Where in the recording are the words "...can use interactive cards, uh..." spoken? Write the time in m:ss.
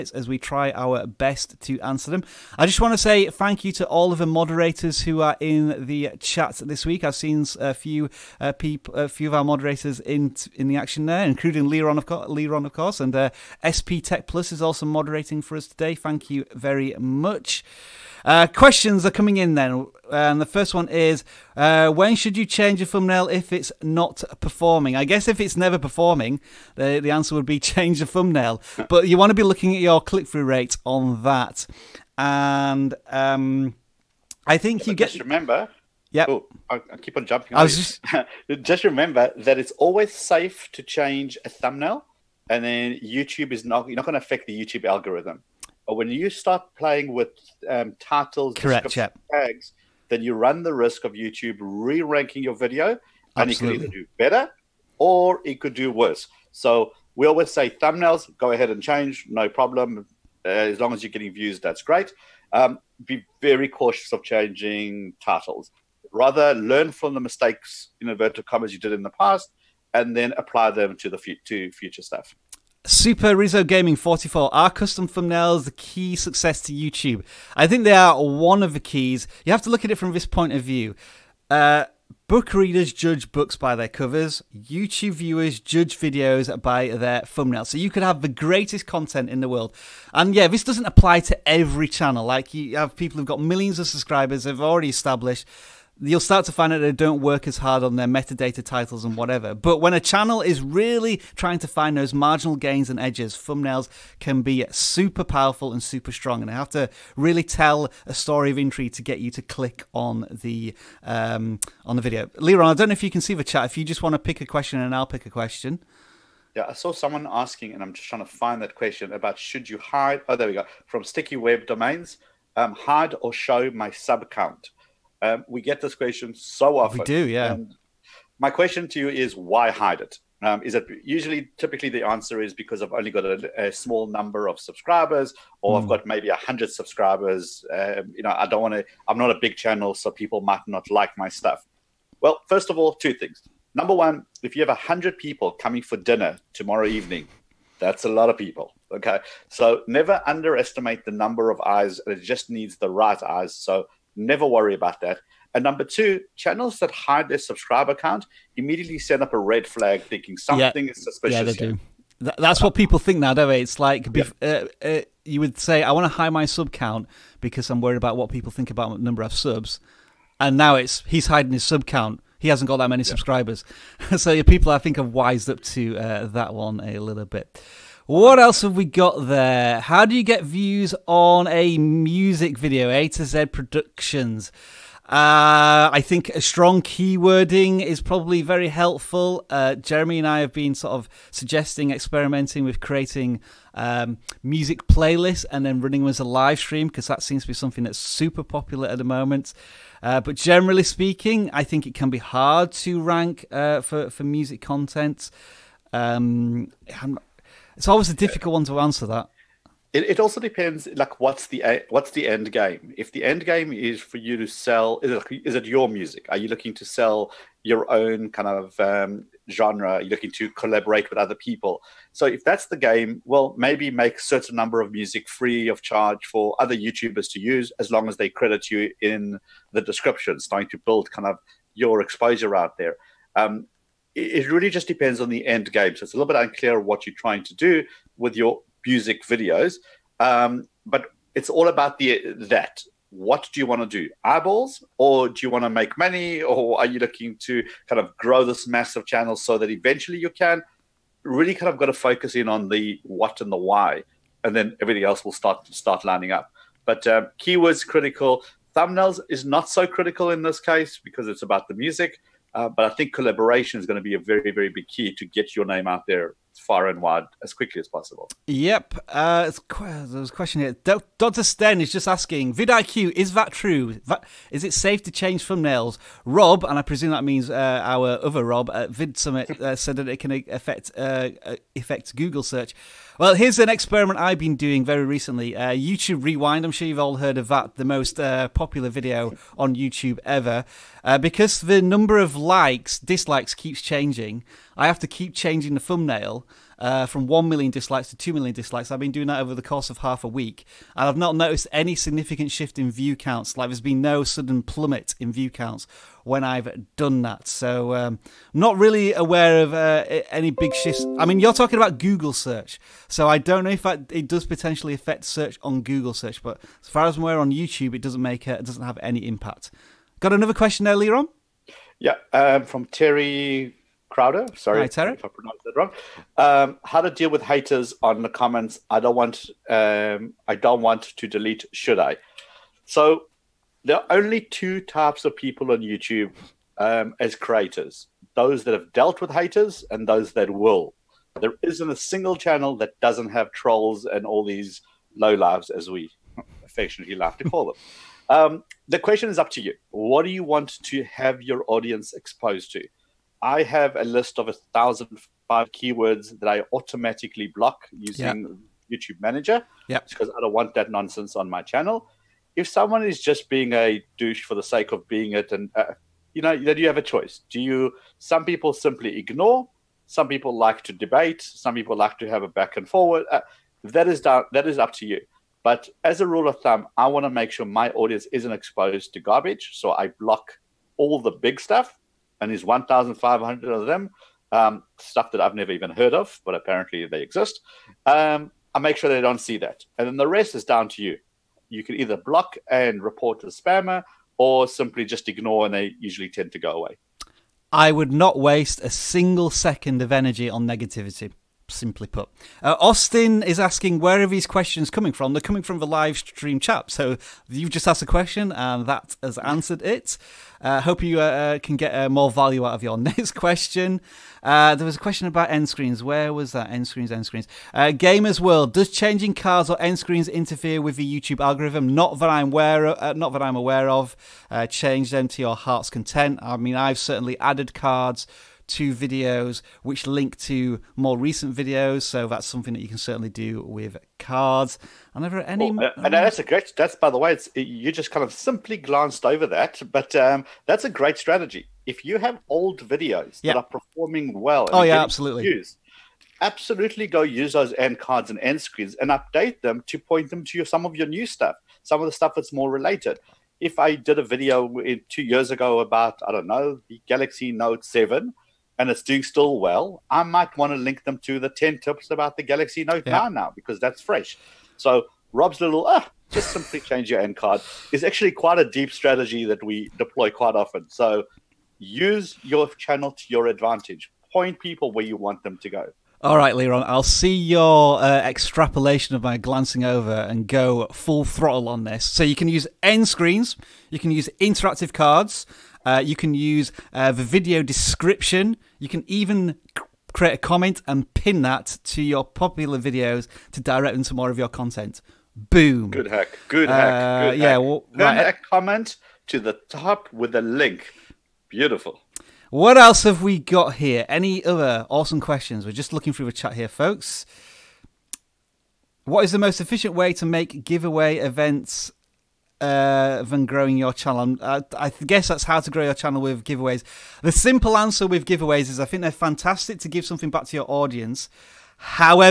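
8:03.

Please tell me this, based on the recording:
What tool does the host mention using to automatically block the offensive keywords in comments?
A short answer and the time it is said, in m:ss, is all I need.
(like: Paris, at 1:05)
YouTube Manager, at 5:58.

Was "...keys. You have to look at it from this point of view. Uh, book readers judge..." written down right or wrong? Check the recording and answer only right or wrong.
right.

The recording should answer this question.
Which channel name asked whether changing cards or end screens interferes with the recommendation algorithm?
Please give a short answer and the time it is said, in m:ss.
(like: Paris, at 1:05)
Gamers World, at 6:57.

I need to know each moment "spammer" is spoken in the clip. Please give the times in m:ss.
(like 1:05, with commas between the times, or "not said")
6:33.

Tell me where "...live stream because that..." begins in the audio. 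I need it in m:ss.
3:16.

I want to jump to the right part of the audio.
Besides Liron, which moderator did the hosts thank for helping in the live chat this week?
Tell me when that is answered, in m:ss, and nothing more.
0:13.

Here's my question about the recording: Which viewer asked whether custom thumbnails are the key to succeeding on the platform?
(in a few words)
Super Rizzo Gaming 44.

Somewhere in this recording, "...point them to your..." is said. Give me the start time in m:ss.
7:29.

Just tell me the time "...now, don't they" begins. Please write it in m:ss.
2:43.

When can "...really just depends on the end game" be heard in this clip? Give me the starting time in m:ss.
3:54.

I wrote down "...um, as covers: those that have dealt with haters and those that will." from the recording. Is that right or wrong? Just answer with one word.
wrong.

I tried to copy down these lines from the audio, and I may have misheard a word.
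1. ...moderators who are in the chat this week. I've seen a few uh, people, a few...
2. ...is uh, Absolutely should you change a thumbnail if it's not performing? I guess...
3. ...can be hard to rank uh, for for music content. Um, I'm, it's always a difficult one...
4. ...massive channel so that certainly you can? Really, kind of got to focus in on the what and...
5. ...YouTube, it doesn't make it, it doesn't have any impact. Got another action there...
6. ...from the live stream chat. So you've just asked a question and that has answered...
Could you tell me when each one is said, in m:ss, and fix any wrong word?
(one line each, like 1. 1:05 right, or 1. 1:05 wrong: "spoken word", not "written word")
1. 0:04 right
2. 0:20 wrong: "When", not "Absolutely"
3. 3:21 right
4. 4:08 wrong: "eventually", not "certainly"
5. 5:17 wrong: "question", not "action"
6. 6:45 right.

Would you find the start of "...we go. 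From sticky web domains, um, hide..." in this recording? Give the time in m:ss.
2:00.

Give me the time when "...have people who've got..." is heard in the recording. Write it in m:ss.
1:32.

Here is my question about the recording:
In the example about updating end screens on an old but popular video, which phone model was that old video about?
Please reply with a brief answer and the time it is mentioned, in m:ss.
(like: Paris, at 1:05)
Galaxy Note 7, at 7:37.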